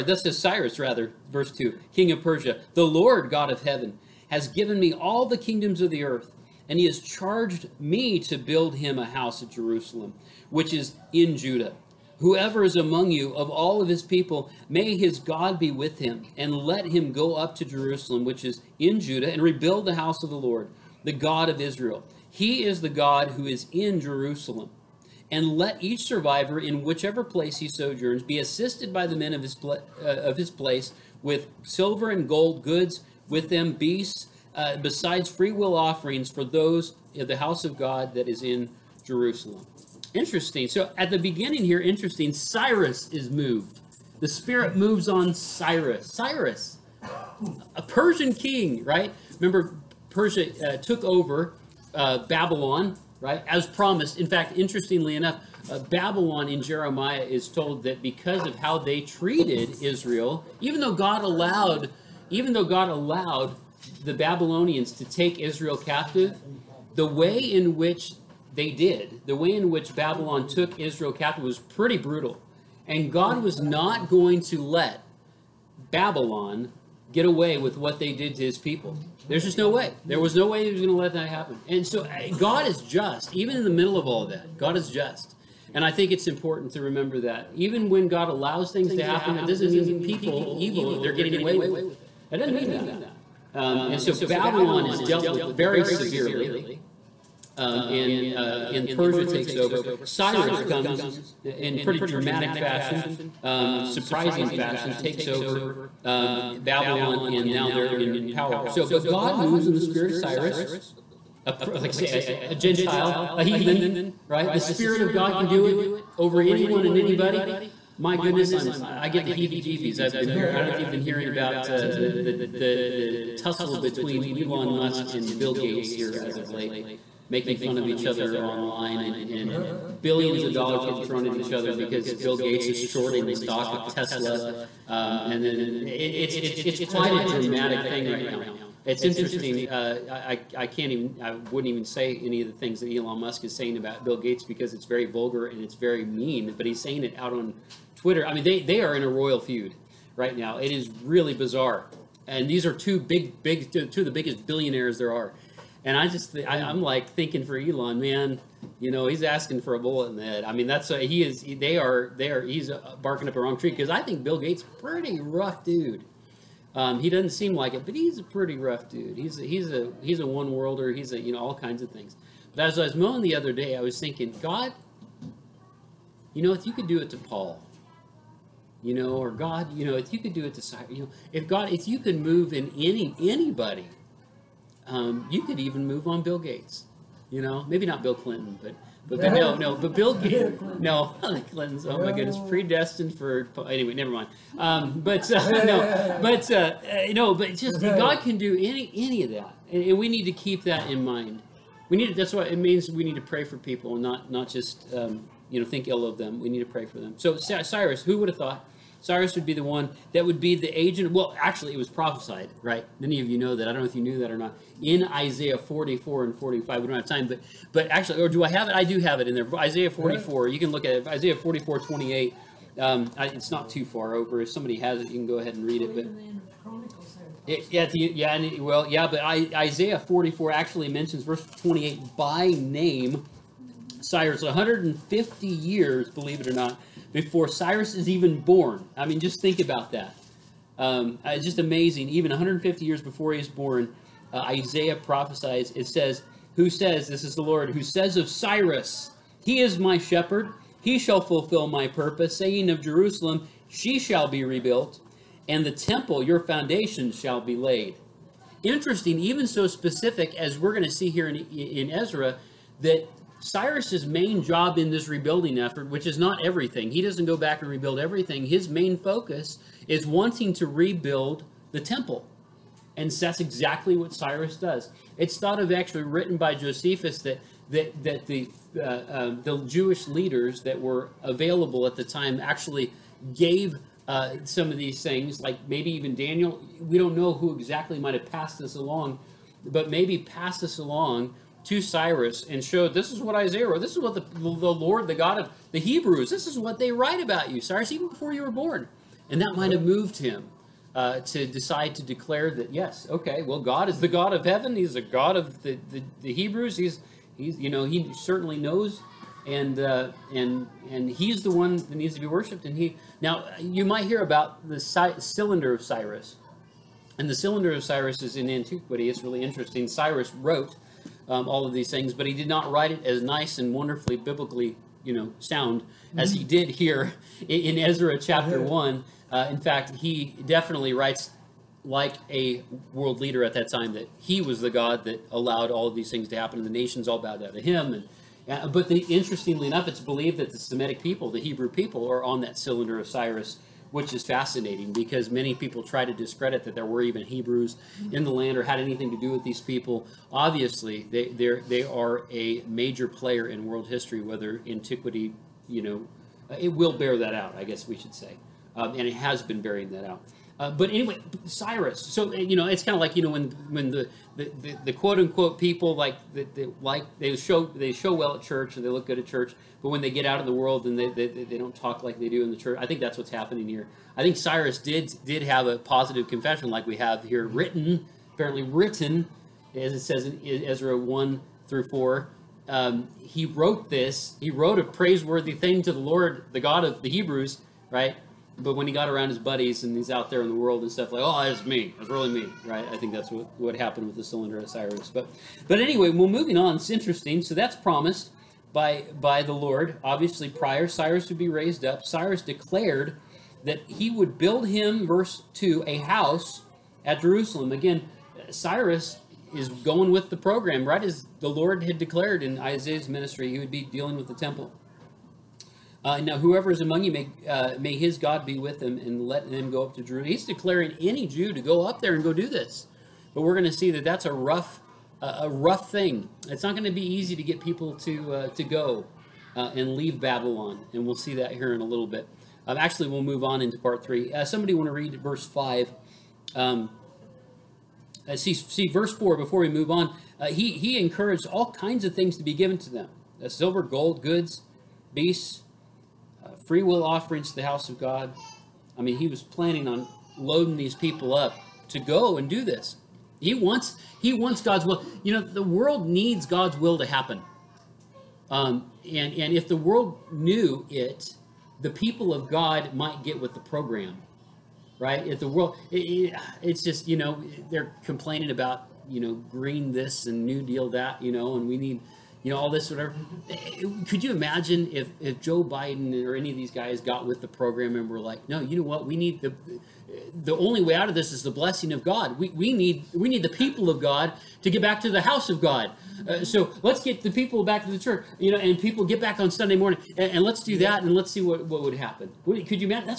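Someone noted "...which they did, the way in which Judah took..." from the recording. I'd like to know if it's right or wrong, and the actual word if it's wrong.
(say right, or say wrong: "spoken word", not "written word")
wrong: "Babylon", not "Judah".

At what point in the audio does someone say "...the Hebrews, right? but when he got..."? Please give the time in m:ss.
6:26.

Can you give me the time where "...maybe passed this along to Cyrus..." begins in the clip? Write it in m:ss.
4:49.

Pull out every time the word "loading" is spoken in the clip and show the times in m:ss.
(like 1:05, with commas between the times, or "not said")
7:30.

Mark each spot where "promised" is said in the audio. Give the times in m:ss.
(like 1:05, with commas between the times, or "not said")
0:53, 6:37.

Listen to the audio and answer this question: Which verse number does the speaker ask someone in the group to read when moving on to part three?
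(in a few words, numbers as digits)
5.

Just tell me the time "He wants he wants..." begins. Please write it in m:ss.
7:33.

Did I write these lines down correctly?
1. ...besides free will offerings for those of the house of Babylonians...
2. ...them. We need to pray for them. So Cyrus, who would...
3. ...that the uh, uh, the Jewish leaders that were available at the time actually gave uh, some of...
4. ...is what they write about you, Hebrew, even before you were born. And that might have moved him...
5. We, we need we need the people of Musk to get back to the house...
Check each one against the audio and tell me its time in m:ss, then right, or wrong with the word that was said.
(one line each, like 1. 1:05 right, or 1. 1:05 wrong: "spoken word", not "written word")
1. 0:34 wrong: "God", not "Babylonians"
2. 3:26 right
3. 4:38 right
4. 4:56 wrong: "Cyrus", not "Hebrew"
5. 8:02 wrong: "God", not "Musk".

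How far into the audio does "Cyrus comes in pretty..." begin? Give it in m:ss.
1:40.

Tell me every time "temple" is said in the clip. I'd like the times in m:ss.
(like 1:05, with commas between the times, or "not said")
4:15, 4:31, 6:54.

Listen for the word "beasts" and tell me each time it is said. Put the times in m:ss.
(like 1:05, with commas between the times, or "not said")
0:33, 7:25.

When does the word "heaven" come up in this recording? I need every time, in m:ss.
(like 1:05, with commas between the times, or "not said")
0:03, 5:04.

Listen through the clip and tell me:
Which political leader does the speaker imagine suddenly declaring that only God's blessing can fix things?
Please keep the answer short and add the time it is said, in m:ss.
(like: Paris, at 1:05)
Joe Biden, at 7:55.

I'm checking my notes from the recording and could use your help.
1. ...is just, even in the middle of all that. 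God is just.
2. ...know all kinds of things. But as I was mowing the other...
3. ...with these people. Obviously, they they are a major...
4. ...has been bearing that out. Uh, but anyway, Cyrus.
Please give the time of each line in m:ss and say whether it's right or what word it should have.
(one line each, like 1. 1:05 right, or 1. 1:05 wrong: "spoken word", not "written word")
1. 1:22 right
2. 2:51 right
3. 5:49 right
4. 5:59 right.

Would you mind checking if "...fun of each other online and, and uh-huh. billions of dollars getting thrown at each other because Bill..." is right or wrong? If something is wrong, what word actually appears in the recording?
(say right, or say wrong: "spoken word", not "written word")
right.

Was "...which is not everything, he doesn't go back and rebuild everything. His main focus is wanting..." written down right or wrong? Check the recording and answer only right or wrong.
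right.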